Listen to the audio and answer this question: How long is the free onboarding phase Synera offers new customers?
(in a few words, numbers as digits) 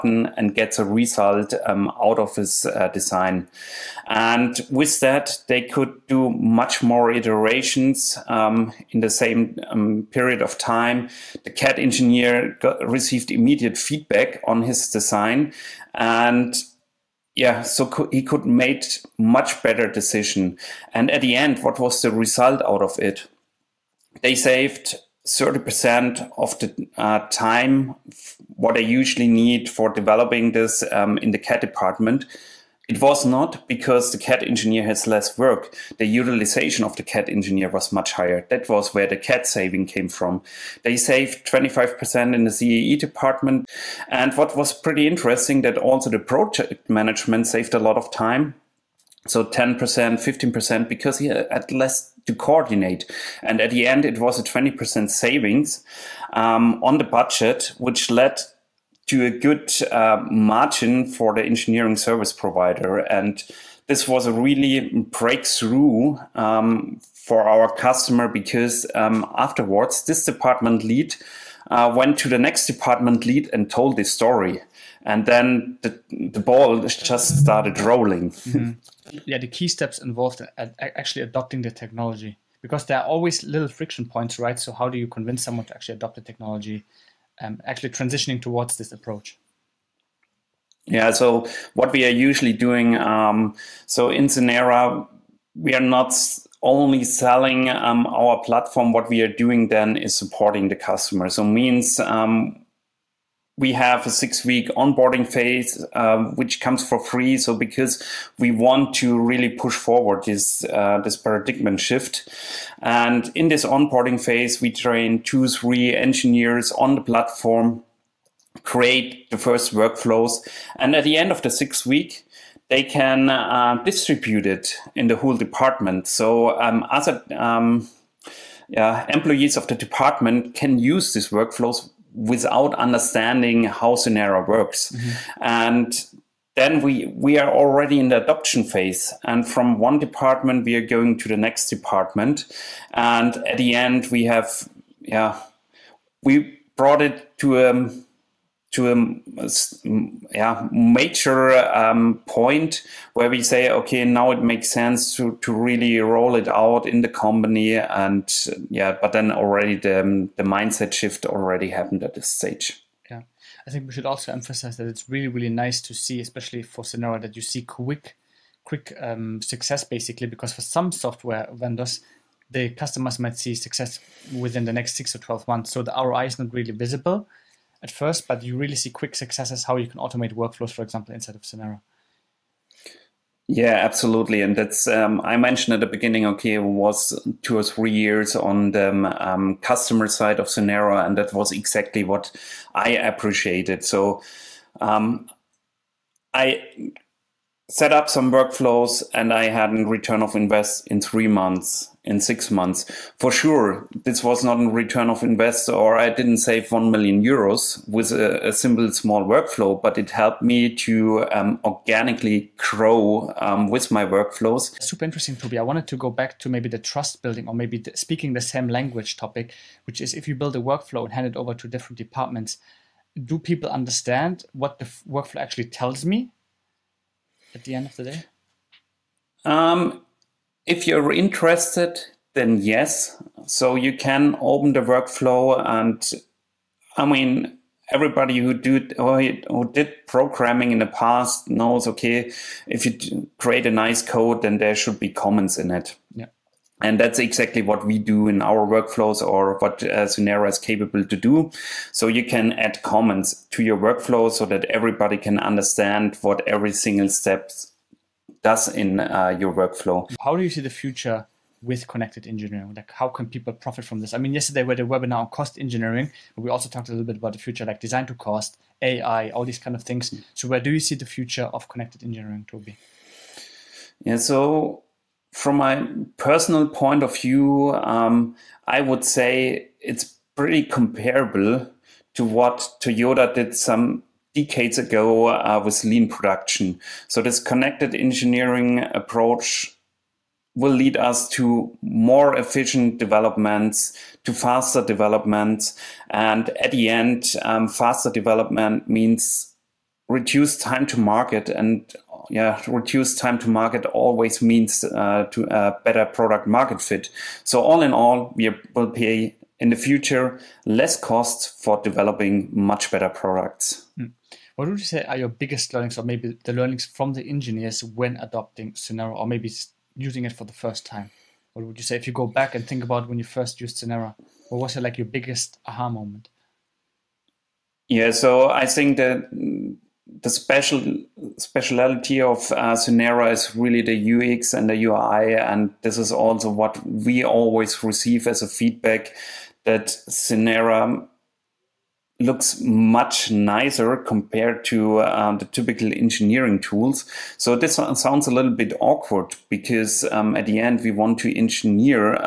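6 weeks.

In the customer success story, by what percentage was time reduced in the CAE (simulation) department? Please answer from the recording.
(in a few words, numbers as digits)
25%.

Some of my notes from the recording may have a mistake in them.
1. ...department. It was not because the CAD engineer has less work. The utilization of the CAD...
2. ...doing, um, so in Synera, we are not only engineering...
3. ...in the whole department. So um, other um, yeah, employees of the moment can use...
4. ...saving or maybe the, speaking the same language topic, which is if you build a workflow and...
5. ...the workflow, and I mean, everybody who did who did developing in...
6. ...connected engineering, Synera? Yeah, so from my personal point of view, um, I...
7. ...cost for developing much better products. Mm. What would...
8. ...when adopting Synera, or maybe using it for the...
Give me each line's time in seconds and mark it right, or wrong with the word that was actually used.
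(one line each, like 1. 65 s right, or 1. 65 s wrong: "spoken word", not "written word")
1. 31 s right
2. 92 s wrong: "selling", not "engineering"
3. 124 s wrong: "department", not "moment"
4. 217 s wrong: "building", not "saving"
5. 234 s wrong: "programming", not "developing"
6. 271 s wrong: "Toby", not "Synera"
7. 310 s right
8. 317 s right.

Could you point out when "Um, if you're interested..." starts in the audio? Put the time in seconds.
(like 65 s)
229 s.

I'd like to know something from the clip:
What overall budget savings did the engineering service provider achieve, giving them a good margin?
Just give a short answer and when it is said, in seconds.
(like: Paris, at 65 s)
20%, at 54 s.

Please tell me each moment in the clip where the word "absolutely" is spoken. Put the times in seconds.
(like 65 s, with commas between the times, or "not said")
183 s.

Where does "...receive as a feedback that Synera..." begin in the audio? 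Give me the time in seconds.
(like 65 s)
337 s.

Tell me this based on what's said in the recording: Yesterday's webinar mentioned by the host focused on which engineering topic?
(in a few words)
Cost engineering.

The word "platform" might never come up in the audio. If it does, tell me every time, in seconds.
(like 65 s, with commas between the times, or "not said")
98 s, 117 s.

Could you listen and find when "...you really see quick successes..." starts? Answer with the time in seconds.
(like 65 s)
178 s.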